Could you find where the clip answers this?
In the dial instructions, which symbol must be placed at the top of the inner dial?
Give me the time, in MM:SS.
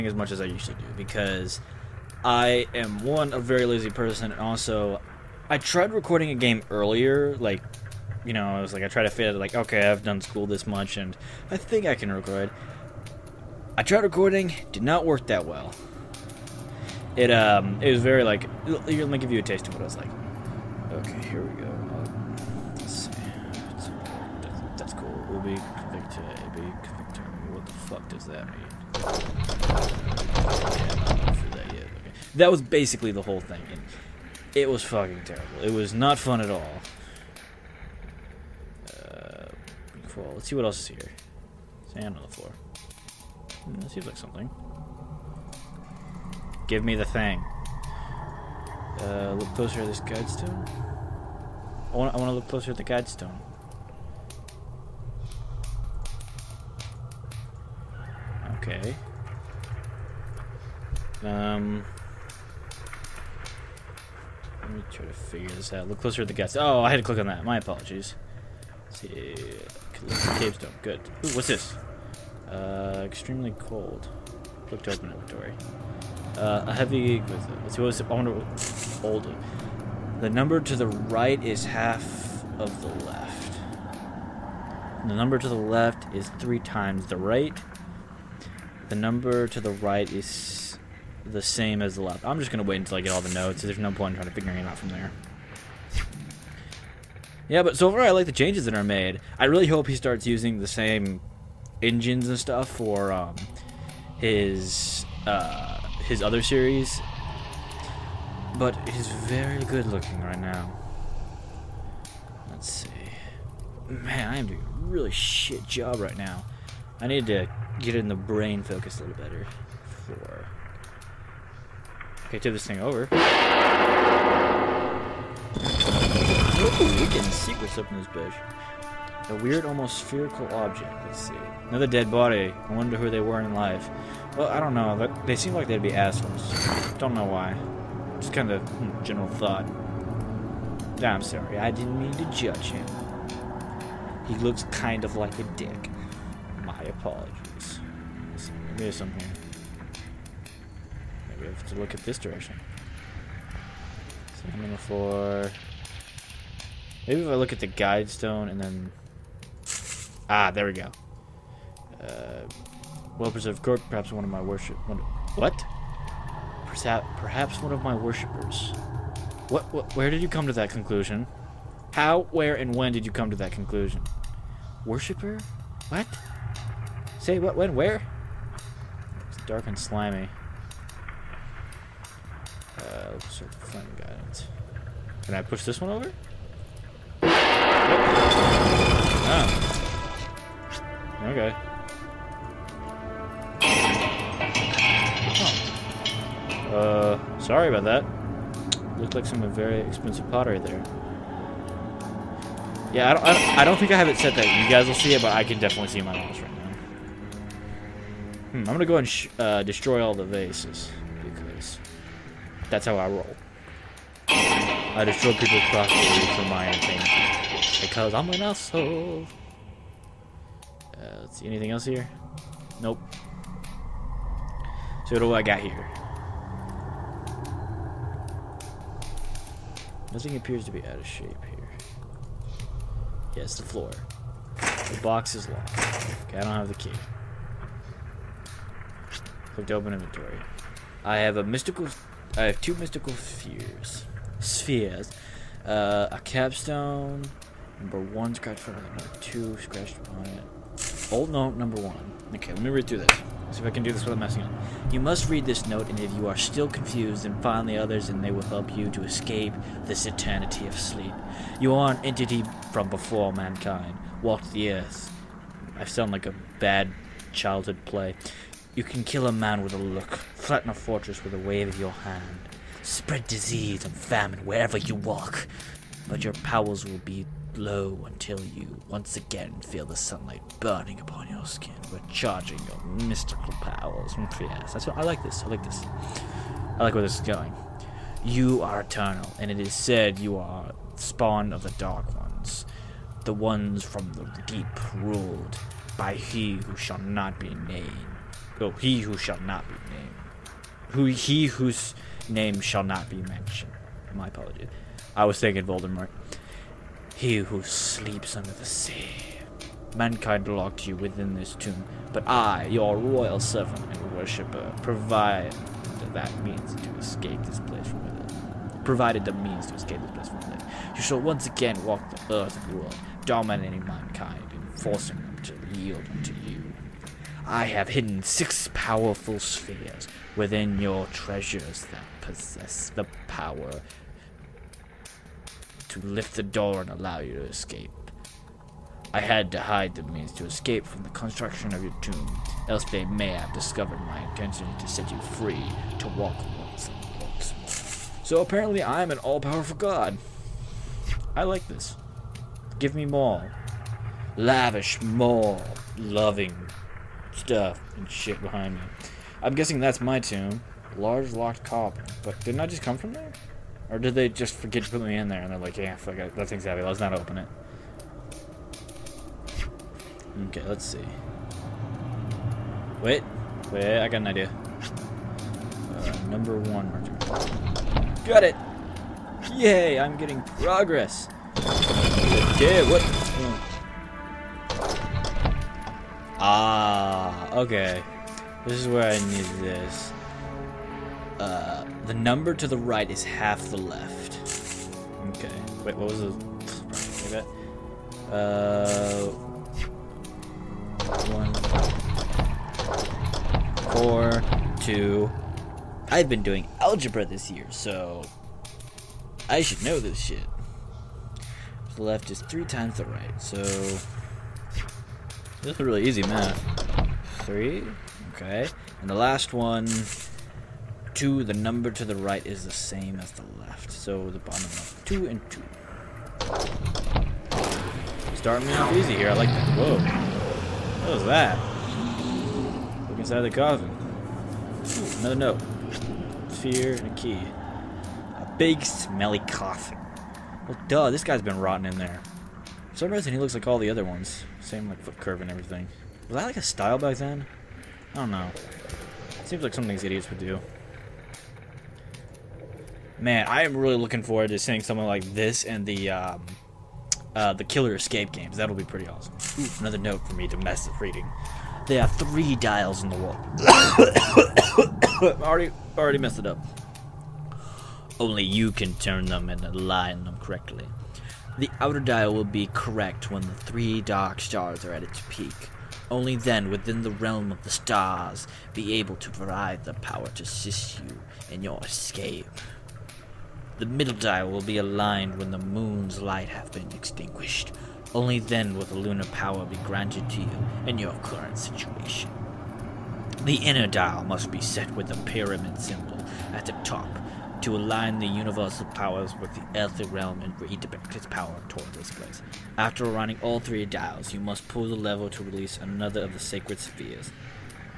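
08:15.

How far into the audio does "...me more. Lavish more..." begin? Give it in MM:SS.
05:52.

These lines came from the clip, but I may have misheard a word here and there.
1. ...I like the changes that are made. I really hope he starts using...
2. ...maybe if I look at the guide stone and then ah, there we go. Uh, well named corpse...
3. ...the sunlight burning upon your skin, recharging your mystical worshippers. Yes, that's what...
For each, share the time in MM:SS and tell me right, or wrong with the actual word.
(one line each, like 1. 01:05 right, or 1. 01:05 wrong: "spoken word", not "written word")
1. 01:38 right
2. 02:37 wrong: "preserved", not "named"
3. 04:39 wrong: "powers", not "worshippers".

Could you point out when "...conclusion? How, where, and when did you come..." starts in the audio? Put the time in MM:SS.
02:50.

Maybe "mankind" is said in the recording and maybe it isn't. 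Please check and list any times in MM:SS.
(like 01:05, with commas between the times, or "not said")
04:23, 05:09, 05:23.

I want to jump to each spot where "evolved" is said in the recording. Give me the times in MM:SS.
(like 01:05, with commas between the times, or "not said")
not said.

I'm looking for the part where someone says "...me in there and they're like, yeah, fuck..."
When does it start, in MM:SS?
06:05.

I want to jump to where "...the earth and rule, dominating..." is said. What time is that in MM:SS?
05:22.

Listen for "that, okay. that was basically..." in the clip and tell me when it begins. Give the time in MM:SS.
00:31.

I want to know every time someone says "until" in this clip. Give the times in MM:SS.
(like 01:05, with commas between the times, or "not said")
01:32, 04:38.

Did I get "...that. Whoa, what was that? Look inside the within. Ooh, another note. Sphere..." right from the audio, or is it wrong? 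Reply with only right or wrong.
wrong.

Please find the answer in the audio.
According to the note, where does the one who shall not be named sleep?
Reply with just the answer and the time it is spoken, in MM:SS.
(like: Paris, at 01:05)
Under the sea, at 05:08.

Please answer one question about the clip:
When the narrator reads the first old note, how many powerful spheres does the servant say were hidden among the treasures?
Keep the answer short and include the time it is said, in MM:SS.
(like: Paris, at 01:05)
6, at 05:28.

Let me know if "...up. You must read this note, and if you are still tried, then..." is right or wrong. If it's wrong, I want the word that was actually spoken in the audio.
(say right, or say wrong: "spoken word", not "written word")
wrong: "confused", not "tried".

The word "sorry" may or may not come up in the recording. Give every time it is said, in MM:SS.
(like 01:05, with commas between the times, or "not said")
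02:21, 03:17.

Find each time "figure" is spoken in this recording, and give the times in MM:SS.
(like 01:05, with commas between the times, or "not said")
01:05, 01:34.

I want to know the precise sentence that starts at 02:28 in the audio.
There's something here negative to look at this direction.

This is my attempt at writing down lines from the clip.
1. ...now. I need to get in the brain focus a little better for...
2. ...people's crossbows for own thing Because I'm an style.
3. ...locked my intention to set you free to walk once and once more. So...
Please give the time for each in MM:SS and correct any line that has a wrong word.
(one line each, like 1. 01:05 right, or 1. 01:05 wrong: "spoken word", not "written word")
1. 01:56 right
2. 03:35 wrong: "asshole", not "style"
3. 05:43 wrong: "discovered", not "locked".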